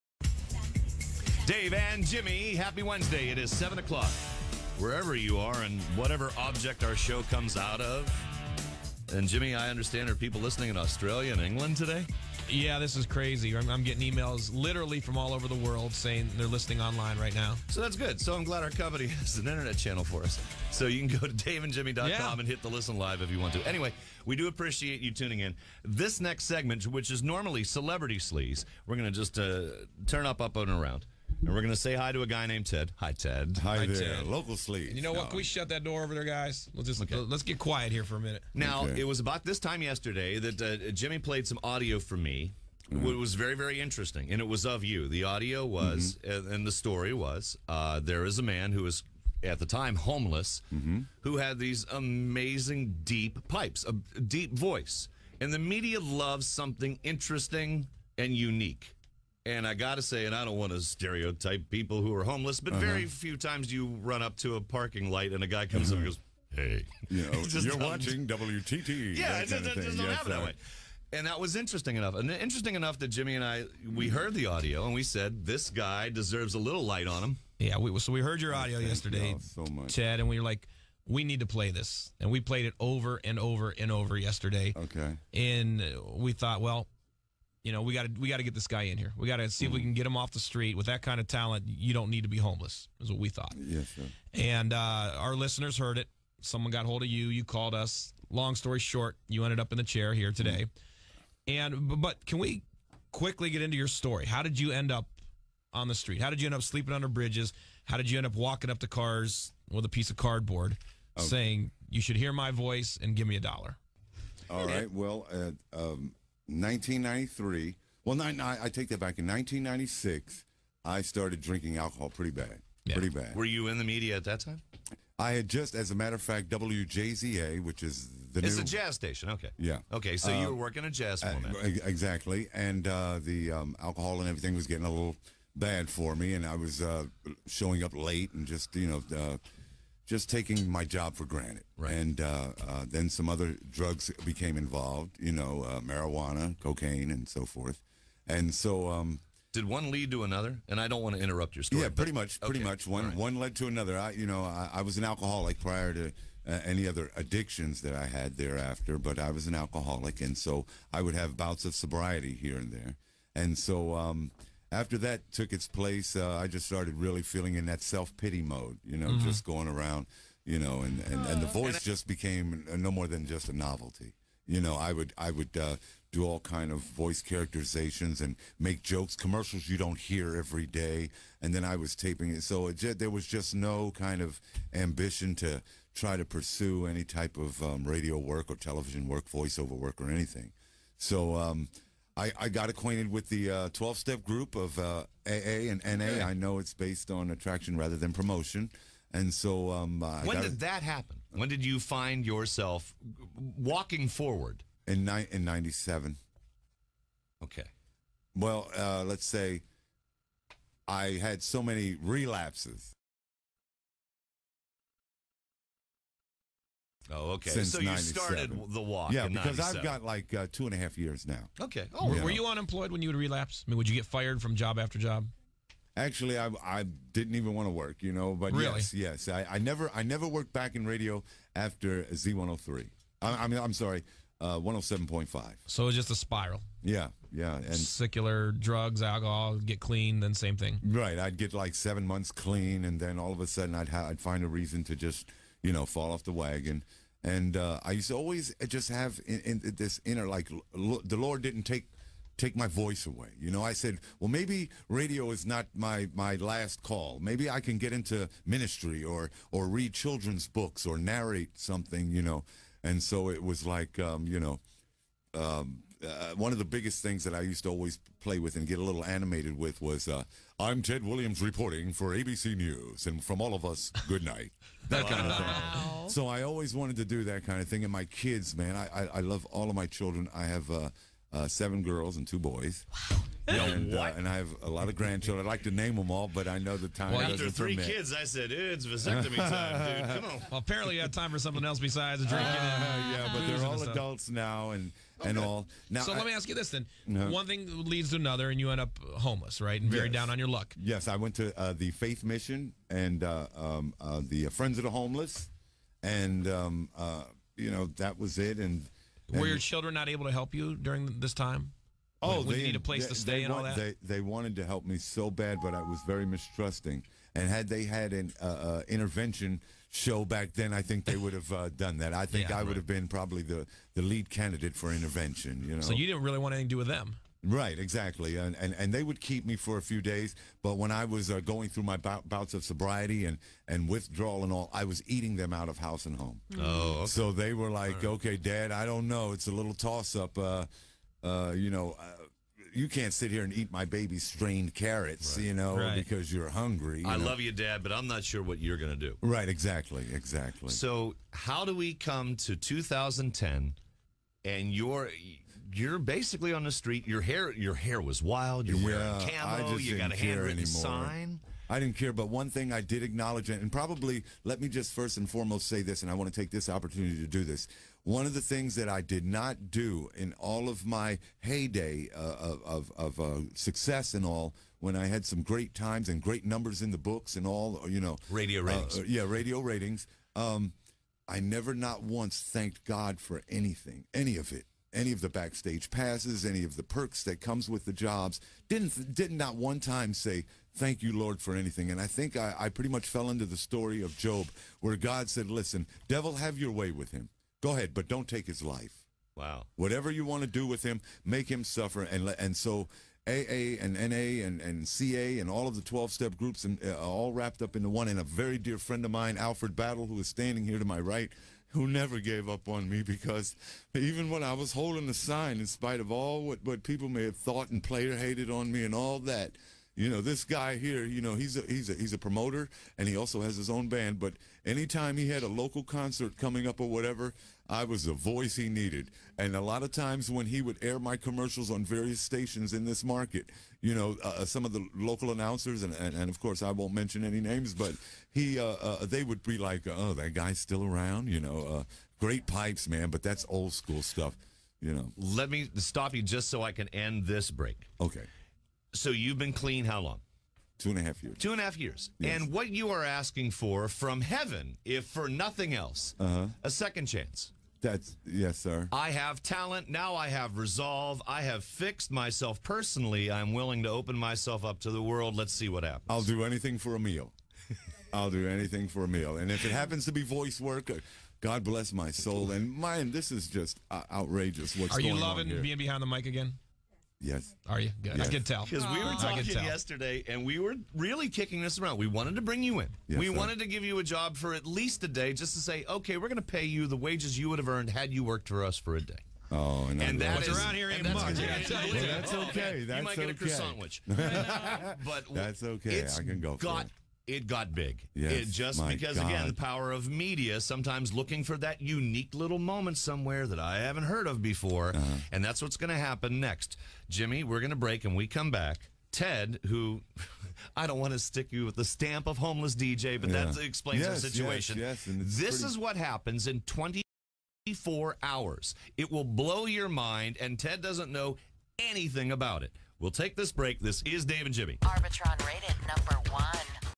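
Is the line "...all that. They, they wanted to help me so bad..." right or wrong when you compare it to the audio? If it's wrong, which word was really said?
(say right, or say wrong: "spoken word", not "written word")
right.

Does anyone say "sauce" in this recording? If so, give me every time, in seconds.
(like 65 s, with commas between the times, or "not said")
not said.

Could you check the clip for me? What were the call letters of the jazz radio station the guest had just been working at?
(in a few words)
WJZA.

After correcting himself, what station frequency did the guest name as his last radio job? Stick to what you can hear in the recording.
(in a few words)
107.5.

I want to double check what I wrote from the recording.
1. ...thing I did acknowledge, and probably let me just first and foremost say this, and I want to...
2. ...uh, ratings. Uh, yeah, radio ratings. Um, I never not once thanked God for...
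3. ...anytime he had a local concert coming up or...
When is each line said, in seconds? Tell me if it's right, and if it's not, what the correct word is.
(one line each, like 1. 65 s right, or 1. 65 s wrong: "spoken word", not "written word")
1. 362 s right
2. 378 s right
3. 424 s right.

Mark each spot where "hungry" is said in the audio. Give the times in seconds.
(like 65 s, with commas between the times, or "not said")
346 s.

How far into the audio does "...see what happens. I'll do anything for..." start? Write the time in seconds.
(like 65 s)
465 s.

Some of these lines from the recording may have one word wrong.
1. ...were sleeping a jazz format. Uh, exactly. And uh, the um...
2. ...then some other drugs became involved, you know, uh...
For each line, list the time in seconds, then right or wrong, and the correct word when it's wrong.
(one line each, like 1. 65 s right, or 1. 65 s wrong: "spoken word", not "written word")
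1. 130 s wrong: "working", not "sleeping"
2. 142 s right.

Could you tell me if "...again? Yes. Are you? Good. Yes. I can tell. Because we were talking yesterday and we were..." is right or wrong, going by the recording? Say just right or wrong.
right.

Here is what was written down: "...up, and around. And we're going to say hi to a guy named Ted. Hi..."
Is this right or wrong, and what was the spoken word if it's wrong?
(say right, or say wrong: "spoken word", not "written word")
right.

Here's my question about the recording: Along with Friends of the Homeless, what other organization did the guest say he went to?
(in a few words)
Faith Mission.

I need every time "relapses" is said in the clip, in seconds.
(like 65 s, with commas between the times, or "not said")
212 s, 223 s.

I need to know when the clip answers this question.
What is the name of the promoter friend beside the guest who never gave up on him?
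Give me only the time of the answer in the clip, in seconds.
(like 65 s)
409 s.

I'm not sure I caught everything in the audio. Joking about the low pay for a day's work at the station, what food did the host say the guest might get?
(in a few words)
croissant sandwich.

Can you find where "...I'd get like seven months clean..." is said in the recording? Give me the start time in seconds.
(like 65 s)
241 s.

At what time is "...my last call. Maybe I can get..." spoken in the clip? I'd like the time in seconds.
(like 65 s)
256 s.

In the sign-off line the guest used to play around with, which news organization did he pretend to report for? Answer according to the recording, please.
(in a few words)
ABC News.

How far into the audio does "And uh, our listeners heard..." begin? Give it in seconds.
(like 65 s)
94 s.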